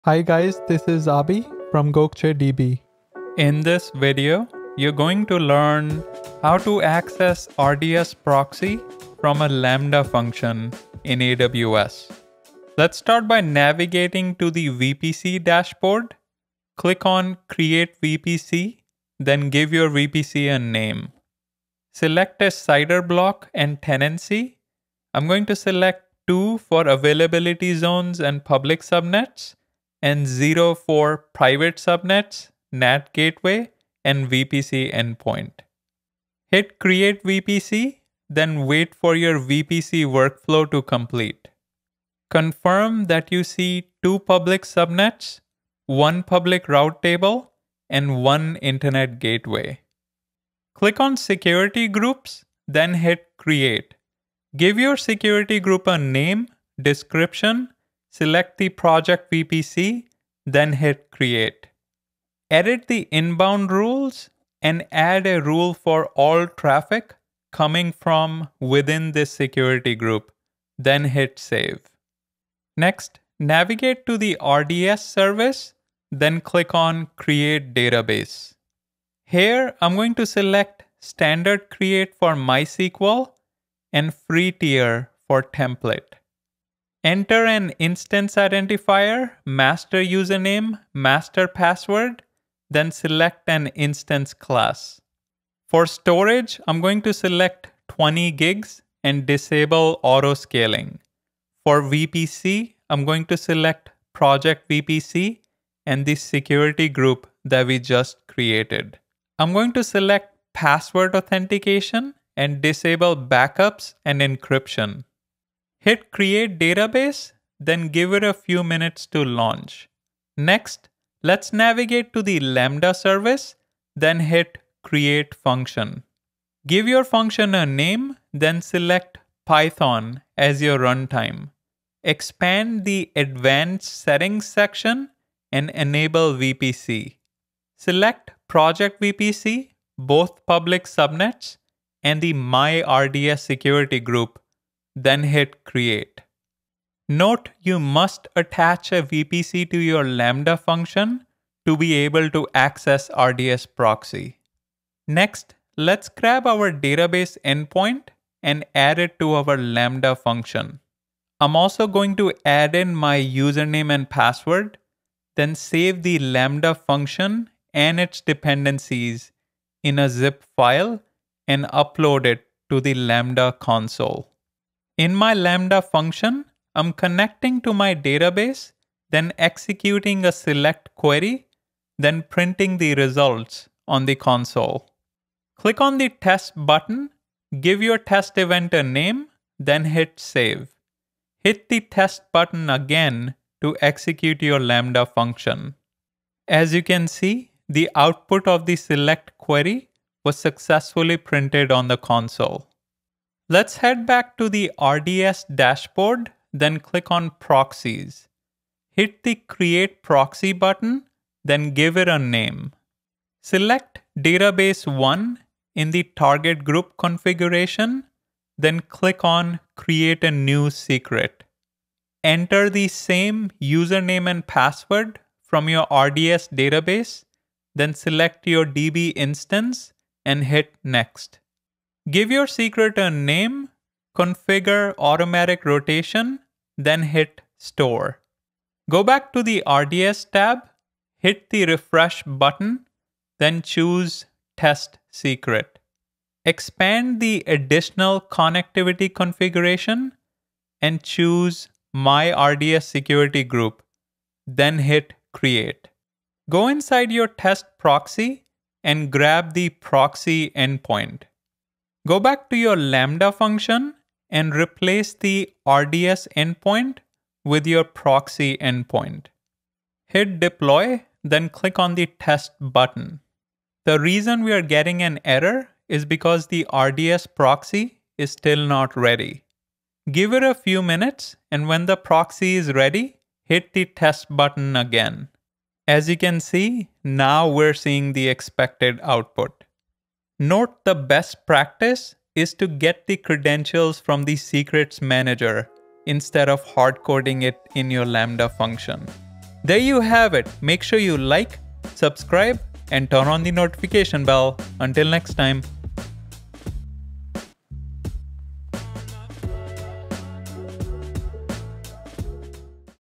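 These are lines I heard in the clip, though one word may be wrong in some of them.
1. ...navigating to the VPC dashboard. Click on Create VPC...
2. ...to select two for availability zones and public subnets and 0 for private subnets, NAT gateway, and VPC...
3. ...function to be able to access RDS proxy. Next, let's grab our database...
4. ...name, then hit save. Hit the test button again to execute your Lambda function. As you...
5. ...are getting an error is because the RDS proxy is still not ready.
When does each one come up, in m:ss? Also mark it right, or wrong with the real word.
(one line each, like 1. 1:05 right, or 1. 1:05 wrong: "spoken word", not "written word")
1. 0:13 right
2. 0:25 right
3. 2:30 right
4. 3:08 right
5. 4:34 right.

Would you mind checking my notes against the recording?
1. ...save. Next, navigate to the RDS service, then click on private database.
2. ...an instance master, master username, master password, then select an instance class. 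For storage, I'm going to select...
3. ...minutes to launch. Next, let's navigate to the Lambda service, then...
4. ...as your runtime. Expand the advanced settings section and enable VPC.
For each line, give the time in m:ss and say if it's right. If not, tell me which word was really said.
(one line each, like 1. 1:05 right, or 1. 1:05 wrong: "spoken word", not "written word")
1. 1:11 wrong: "create", not "private"
2. 1:27 wrong: "identifier", not "master"
3. 1:58 right
4. 2:10 right.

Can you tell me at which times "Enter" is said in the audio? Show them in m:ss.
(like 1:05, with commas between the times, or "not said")
1:27, 3:42.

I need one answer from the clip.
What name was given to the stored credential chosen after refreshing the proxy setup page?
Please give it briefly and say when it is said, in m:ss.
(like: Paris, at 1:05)
test secret, at 4:04.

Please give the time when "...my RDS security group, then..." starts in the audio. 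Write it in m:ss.
4:11.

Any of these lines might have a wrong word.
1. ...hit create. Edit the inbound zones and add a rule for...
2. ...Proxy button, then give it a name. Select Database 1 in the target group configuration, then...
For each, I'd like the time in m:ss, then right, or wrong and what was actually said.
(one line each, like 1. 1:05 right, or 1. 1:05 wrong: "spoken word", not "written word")
1. 1:00 wrong: "rules", not "zones"
2. 3:30 right.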